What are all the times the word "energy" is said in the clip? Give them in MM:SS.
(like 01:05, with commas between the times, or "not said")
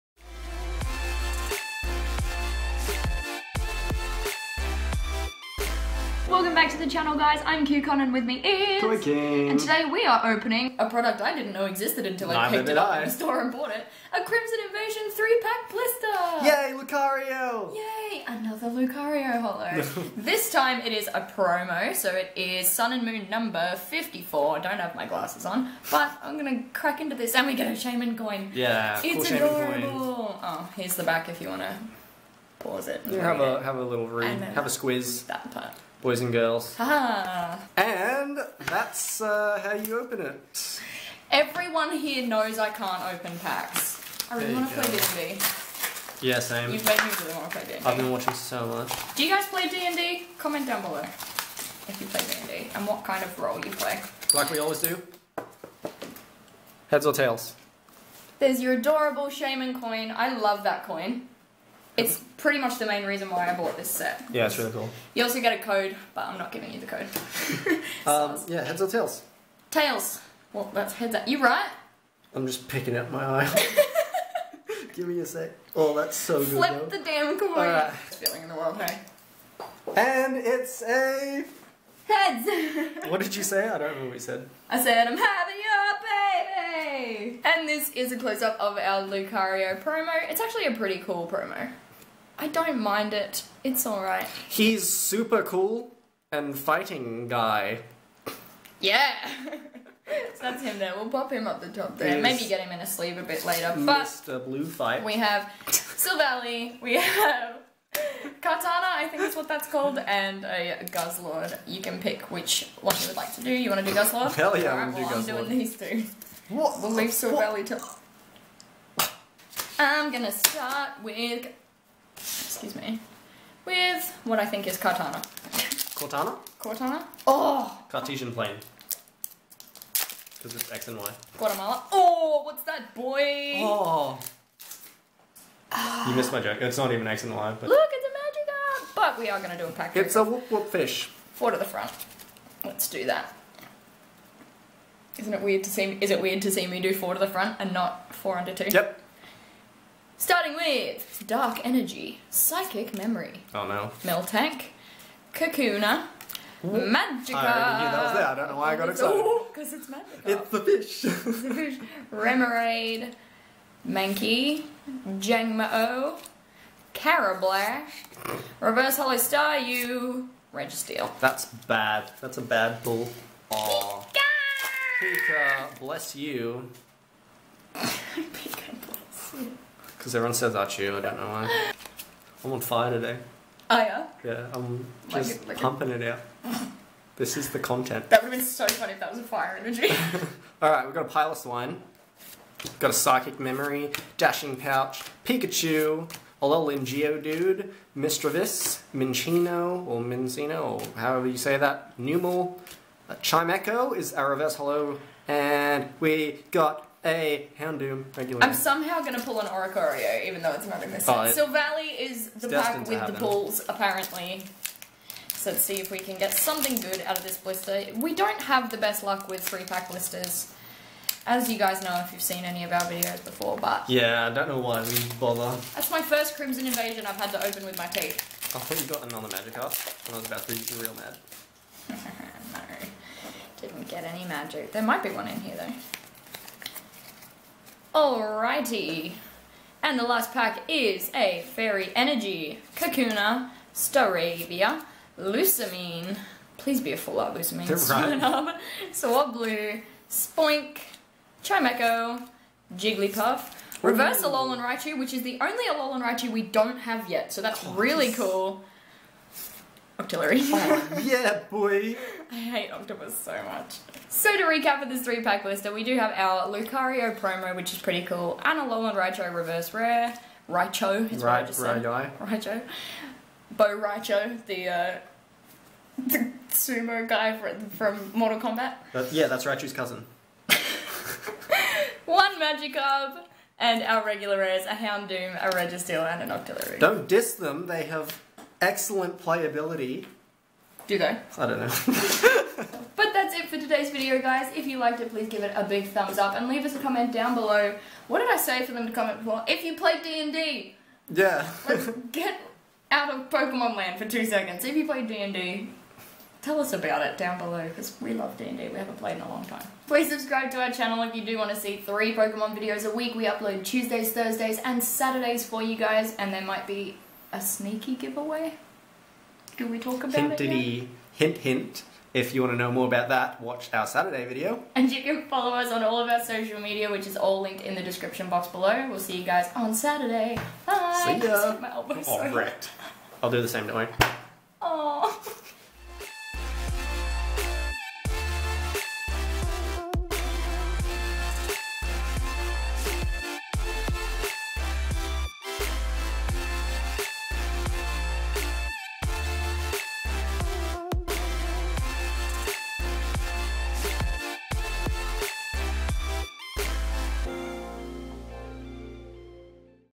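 02:31, 03:09, 04:01.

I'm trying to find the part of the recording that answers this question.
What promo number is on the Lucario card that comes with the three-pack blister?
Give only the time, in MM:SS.
00:22.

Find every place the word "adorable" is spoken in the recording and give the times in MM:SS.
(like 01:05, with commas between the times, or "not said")
00:29, 00:58.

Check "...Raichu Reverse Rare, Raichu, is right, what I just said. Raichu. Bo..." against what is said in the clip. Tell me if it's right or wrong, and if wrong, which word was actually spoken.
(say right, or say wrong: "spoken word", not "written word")
right.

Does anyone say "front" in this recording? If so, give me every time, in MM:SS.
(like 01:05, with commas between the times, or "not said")
02:21, 02:27.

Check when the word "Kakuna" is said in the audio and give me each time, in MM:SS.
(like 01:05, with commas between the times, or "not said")
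02:35, 04:02.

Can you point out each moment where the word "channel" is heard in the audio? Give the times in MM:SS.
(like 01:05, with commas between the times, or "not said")
00:06, 05:10.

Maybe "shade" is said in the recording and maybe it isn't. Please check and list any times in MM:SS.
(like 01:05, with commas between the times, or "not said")
not said.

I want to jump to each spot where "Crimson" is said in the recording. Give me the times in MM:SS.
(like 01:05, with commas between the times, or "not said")
00:14, 03:46.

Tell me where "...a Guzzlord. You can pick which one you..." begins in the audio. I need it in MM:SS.
01:50.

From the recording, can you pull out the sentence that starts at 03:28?
I'm somehow going to pull an Oricorio, even though it's not in this oh, set.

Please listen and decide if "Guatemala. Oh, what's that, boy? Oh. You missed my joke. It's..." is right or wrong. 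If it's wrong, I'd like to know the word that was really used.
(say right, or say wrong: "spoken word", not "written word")
right.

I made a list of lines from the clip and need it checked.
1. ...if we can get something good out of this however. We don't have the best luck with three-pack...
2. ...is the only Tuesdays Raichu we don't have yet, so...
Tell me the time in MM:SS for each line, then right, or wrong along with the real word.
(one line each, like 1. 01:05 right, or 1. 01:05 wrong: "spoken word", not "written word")
1. 03:35 wrong: "blister", not "however"
2. 04:15 wrong: "Alolan", not "Tuesdays".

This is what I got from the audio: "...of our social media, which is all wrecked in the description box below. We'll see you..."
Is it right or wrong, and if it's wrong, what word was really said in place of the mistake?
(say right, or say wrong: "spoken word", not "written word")
wrong: "linked", not "wrecked".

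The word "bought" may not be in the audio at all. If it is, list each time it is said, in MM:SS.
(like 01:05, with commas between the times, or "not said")
00:13, 01:03.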